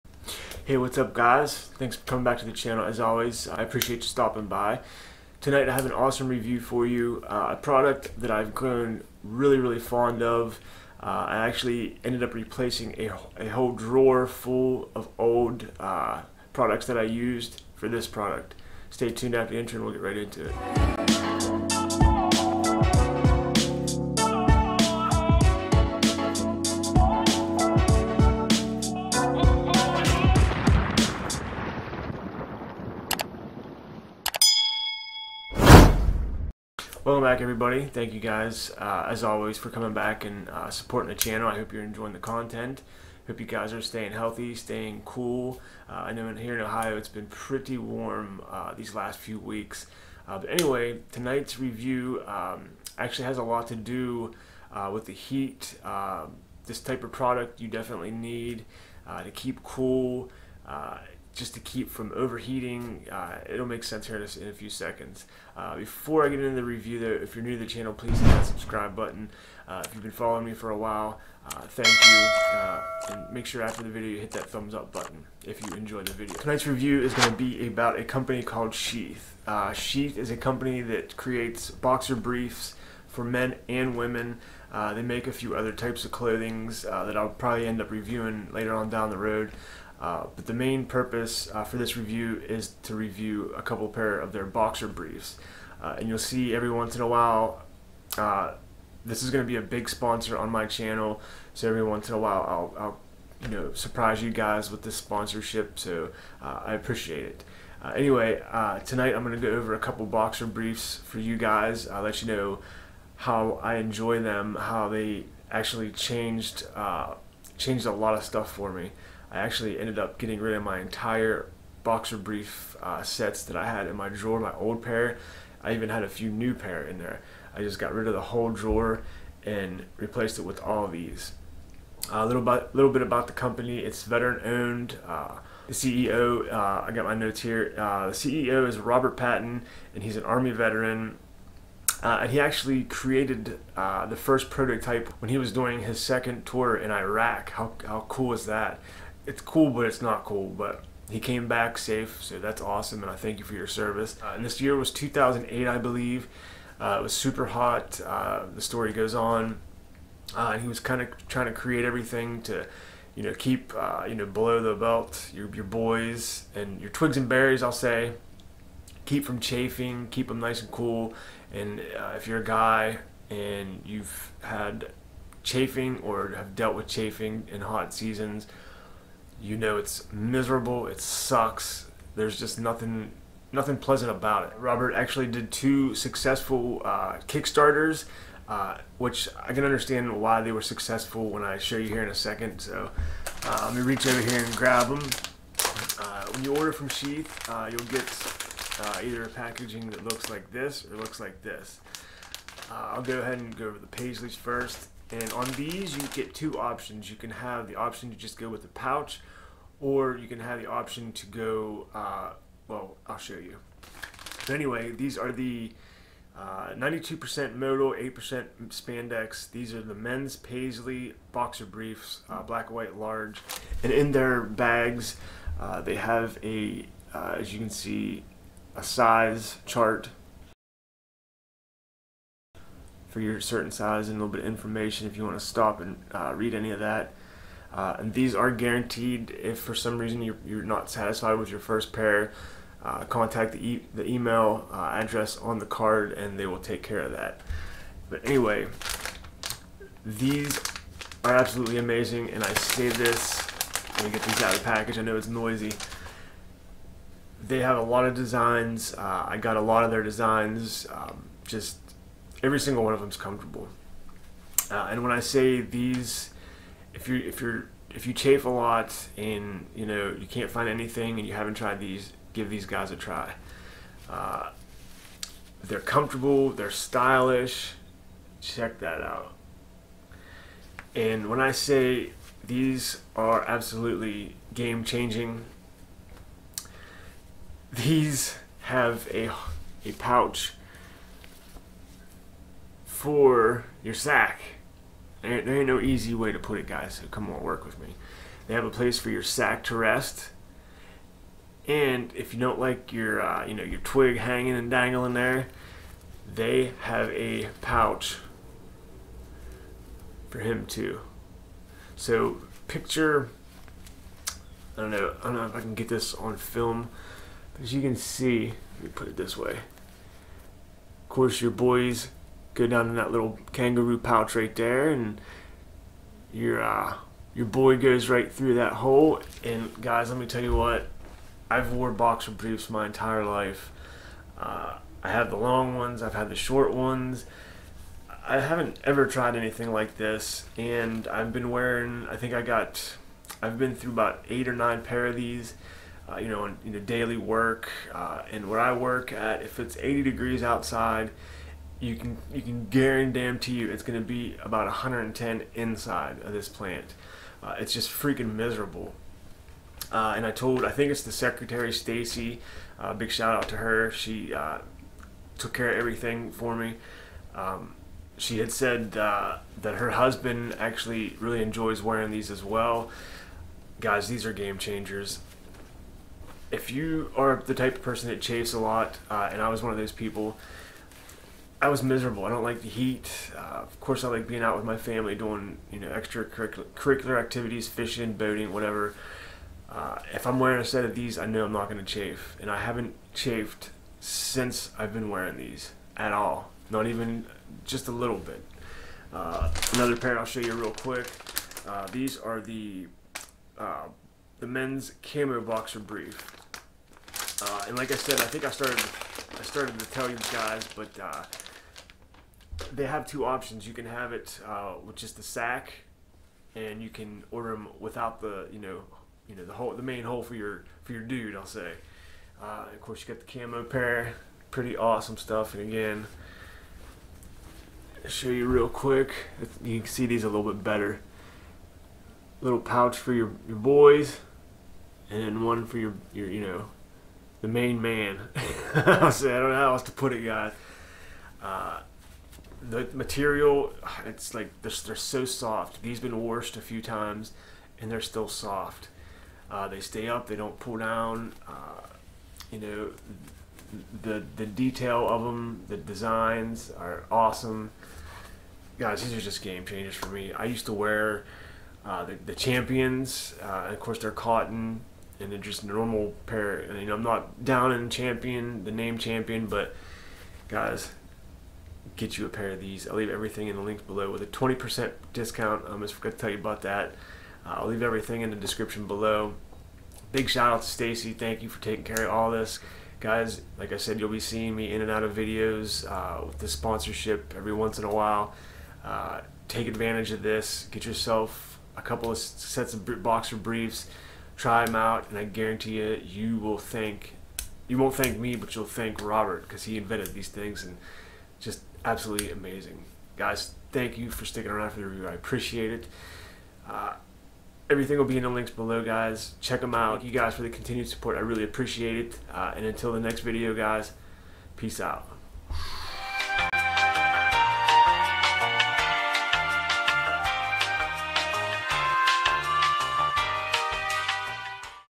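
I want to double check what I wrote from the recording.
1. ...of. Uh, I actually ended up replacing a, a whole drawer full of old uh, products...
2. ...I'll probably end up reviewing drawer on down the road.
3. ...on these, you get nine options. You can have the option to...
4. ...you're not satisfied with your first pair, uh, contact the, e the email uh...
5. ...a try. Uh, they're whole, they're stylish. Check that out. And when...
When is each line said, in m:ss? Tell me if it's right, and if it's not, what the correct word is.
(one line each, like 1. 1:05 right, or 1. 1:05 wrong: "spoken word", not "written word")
1. 0:10 right
2. 1:27 wrong: "later", not "drawer"
3. 3:25 wrong: "two", not "nine"
4. 4:00 right
5. 4:32 wrong: "comfortable", not "whole".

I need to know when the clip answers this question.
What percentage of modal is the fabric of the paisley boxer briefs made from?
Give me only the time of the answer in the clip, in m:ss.
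3:36.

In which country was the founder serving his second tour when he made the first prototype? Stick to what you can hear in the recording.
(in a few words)
Iraq.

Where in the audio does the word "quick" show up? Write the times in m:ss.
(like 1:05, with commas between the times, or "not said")
6:40, 7:08.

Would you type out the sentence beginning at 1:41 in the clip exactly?
So every once in a while, I'll, I'll you know surprise you guys with this sponsorship.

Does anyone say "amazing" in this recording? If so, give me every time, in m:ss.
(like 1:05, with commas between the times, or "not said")
4:11, 8:22.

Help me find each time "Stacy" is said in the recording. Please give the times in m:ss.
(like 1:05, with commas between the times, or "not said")
6:01, 8:00.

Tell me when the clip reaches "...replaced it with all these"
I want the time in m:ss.
2:09.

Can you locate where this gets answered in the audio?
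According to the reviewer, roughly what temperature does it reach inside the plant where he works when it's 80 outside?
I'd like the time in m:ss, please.
5:54.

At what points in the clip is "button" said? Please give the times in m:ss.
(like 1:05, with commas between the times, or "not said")
1:08, 1:14.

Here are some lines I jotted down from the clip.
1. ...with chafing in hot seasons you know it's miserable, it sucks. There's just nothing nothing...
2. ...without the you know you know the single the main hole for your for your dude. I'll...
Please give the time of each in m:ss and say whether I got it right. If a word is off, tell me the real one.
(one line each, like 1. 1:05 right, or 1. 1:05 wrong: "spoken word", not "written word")
1. 2:56 right
2. 6:57 wrong: "whole", not "single".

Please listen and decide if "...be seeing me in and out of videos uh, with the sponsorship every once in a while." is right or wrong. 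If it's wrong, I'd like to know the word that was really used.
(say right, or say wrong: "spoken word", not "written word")
right.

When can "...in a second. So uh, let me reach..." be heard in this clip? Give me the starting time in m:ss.
3:12.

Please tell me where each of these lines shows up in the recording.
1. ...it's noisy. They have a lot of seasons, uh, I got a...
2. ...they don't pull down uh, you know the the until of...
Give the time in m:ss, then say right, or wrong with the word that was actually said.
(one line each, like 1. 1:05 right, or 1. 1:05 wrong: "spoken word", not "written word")
1. 4:15 wrong: "designs", not "seasons"
2. 7:30 wrong: "detail", not "until".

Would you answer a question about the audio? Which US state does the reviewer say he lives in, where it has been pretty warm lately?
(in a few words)
Ohio.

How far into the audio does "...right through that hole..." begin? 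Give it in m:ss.
5:28.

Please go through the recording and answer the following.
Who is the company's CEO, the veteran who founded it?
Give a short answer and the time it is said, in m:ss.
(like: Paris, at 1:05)
Robert Patton, at 2:18.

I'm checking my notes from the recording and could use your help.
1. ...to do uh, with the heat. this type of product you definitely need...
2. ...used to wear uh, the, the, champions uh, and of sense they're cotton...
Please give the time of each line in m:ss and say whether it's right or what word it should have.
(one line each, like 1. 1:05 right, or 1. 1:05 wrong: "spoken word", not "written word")
1. 0:53 right
2. 7:40 wrong: "course", not "sense".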